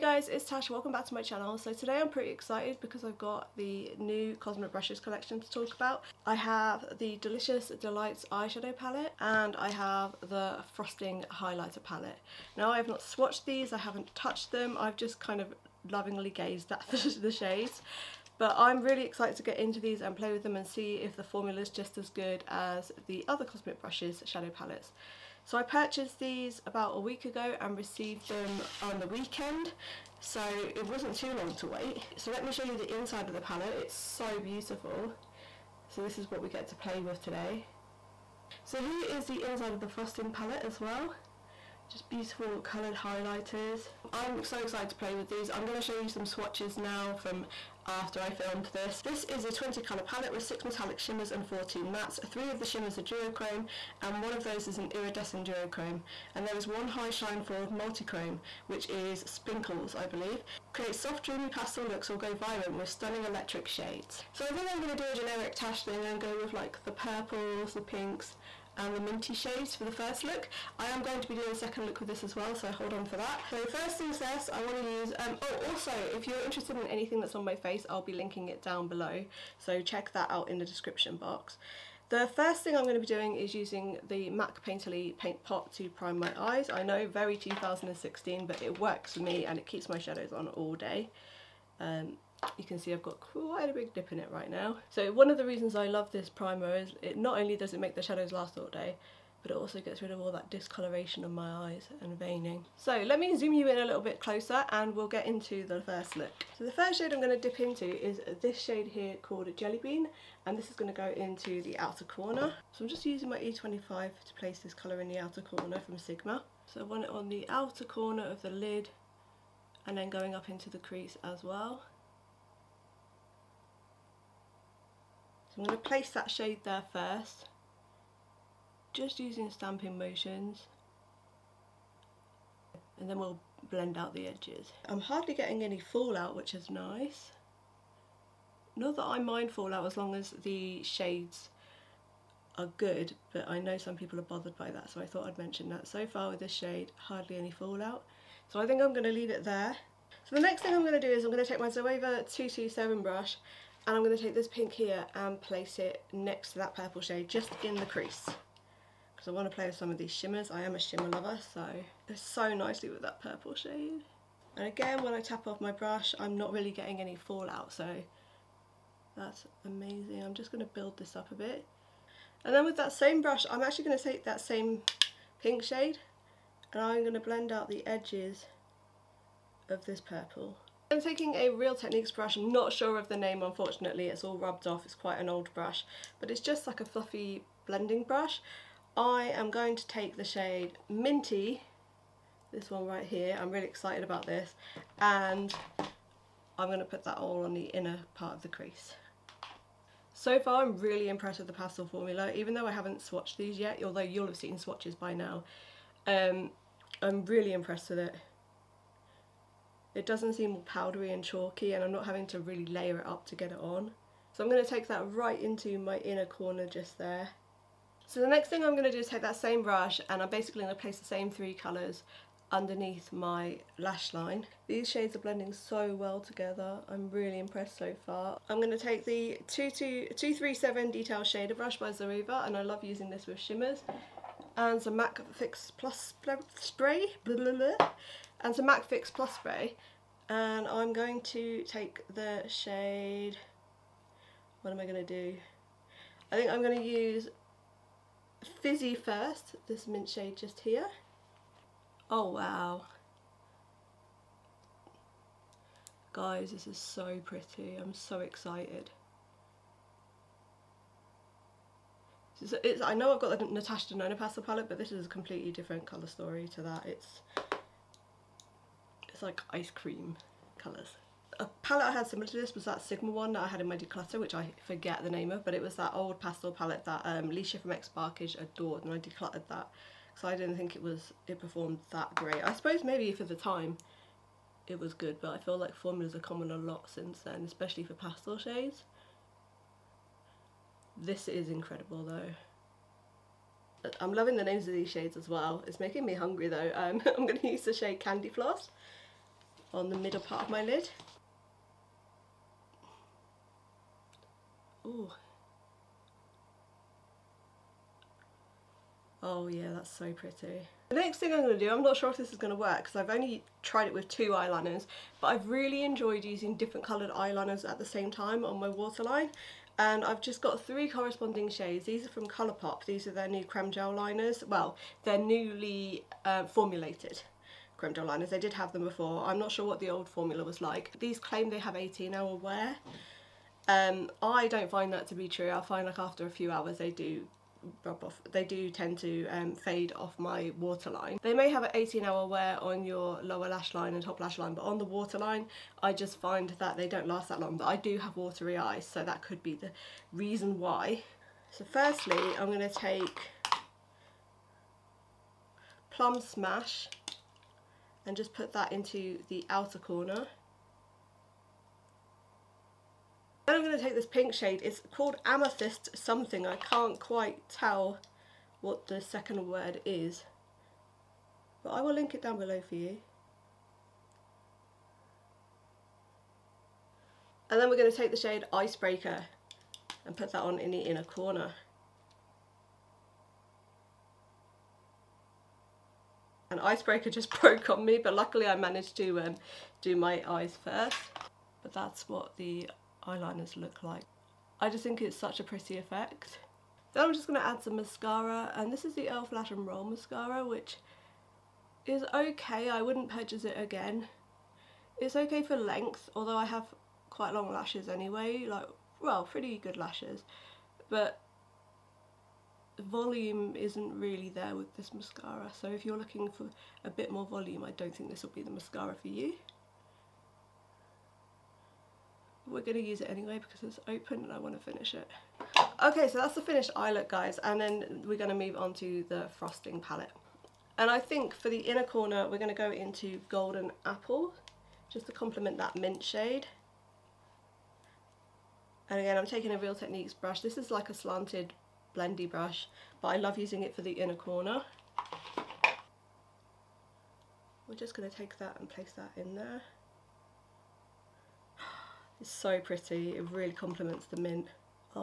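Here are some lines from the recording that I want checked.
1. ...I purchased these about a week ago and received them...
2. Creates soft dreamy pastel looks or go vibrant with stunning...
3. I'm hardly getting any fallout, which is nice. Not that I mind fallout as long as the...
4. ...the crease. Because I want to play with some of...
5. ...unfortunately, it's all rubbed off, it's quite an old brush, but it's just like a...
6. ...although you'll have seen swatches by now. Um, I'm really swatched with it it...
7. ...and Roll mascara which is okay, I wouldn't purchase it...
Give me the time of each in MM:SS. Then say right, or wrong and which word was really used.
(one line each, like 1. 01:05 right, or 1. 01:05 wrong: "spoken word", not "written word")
1. 00:25 right
2. 01:00 right
3. 02:14 right
4. 02:37 right
5. 03:03 right
6. 03:23 wrong: "impressed", not "swatched"
7. 06:39 right.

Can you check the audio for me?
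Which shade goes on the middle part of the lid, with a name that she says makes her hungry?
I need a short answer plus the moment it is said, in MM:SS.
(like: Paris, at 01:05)
Candy Floss, at 04:57.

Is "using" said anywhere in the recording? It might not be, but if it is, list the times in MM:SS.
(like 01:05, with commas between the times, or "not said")
01:23, 01:53, 02:09, 03:52, 05:16, 07:23.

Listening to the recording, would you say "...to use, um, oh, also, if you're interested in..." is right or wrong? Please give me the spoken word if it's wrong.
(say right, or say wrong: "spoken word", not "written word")
right.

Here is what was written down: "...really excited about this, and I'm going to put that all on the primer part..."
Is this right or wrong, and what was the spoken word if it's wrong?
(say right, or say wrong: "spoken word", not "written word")
wrong: "inner", not "primer".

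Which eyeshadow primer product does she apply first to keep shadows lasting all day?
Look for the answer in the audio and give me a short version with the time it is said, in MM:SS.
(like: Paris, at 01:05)
MAC Painterly Paint Pot, at 01:24.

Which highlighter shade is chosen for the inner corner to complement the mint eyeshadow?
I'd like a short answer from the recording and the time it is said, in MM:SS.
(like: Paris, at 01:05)
Golden Apple, at 07:13.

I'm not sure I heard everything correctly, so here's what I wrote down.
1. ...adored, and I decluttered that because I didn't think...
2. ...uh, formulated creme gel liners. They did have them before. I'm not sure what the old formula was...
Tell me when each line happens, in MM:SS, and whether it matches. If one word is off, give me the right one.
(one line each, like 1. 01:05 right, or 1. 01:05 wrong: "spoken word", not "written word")
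1. 04:38 right
2. 05:26 right.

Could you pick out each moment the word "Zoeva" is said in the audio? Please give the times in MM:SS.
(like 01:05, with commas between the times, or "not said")
02:31, 03:51.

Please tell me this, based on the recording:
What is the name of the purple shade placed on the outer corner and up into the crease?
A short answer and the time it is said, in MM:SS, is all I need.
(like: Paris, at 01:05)
Jelly Bean, at 01:49.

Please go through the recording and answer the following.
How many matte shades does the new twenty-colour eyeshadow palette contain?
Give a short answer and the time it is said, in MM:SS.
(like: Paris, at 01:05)
14, at 00:51.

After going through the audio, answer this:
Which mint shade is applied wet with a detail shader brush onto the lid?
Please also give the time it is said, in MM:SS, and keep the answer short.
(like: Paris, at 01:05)
Fizzy, at 04:08.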